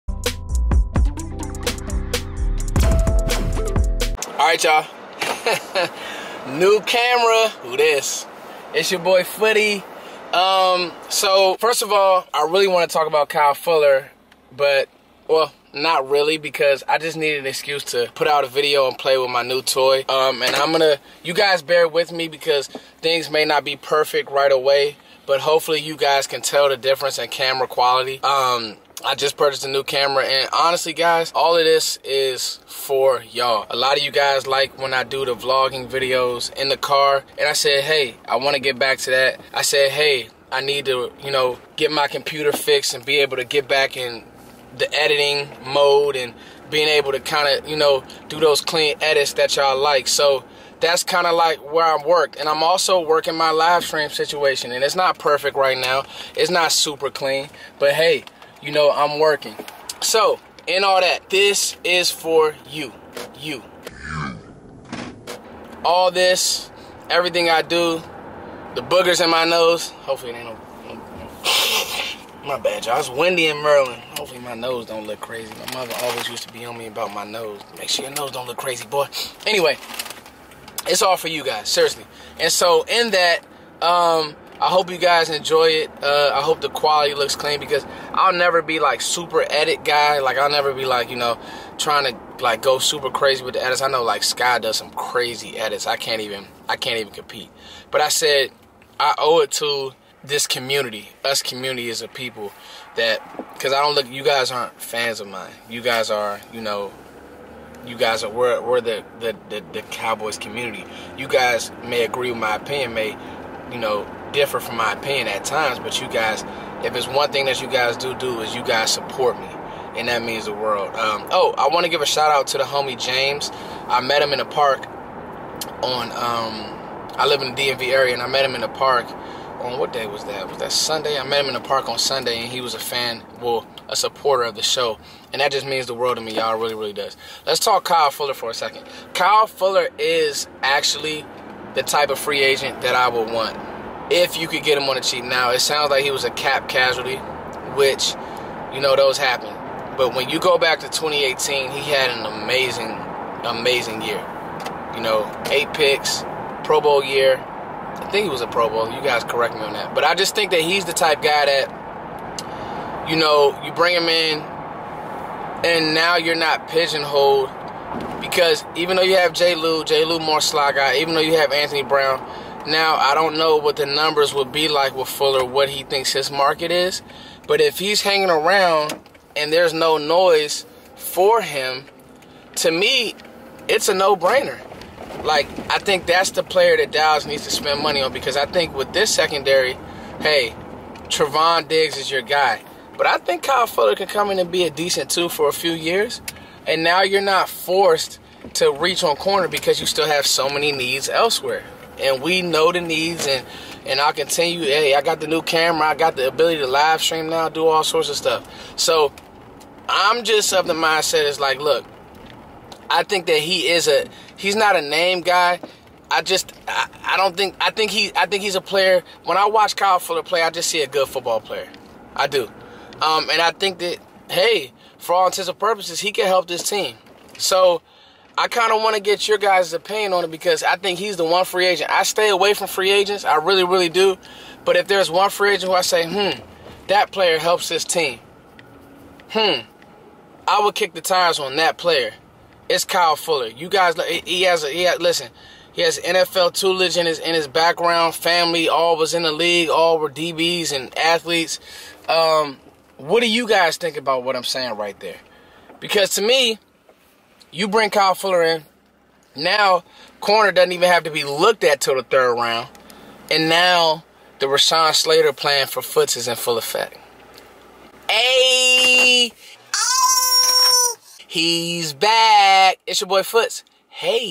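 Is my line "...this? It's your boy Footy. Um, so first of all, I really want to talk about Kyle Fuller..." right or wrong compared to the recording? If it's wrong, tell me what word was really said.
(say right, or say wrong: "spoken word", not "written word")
right.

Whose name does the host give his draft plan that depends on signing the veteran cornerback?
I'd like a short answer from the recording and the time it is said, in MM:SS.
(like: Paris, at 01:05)
Rashawn Slater, at 04:24.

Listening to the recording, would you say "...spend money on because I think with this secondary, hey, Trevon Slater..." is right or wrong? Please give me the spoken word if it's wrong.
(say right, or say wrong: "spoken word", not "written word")
wrong: "Diggs", not "Slater".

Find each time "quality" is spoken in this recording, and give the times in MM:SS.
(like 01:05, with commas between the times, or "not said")
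00:27, 01:26.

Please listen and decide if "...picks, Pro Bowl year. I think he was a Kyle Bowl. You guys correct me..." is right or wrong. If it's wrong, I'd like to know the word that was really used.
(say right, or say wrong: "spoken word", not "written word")
wrong: "Pro", not "Kyle".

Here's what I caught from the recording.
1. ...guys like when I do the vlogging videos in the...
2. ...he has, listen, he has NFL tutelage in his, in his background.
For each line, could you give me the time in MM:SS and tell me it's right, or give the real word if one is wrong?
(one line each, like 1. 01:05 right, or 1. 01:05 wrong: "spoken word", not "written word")
1. 00:34 right
2. 04:04 right.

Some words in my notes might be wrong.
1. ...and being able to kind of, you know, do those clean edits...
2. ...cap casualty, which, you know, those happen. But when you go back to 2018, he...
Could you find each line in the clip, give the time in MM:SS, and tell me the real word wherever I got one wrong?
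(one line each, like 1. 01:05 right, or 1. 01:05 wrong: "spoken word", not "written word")
1. 00:46 right
2. 02:26 right.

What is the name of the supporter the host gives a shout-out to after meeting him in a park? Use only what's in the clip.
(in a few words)
James.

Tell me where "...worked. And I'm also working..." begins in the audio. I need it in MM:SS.
00:52.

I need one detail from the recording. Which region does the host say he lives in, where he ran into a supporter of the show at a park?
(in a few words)
DMV area.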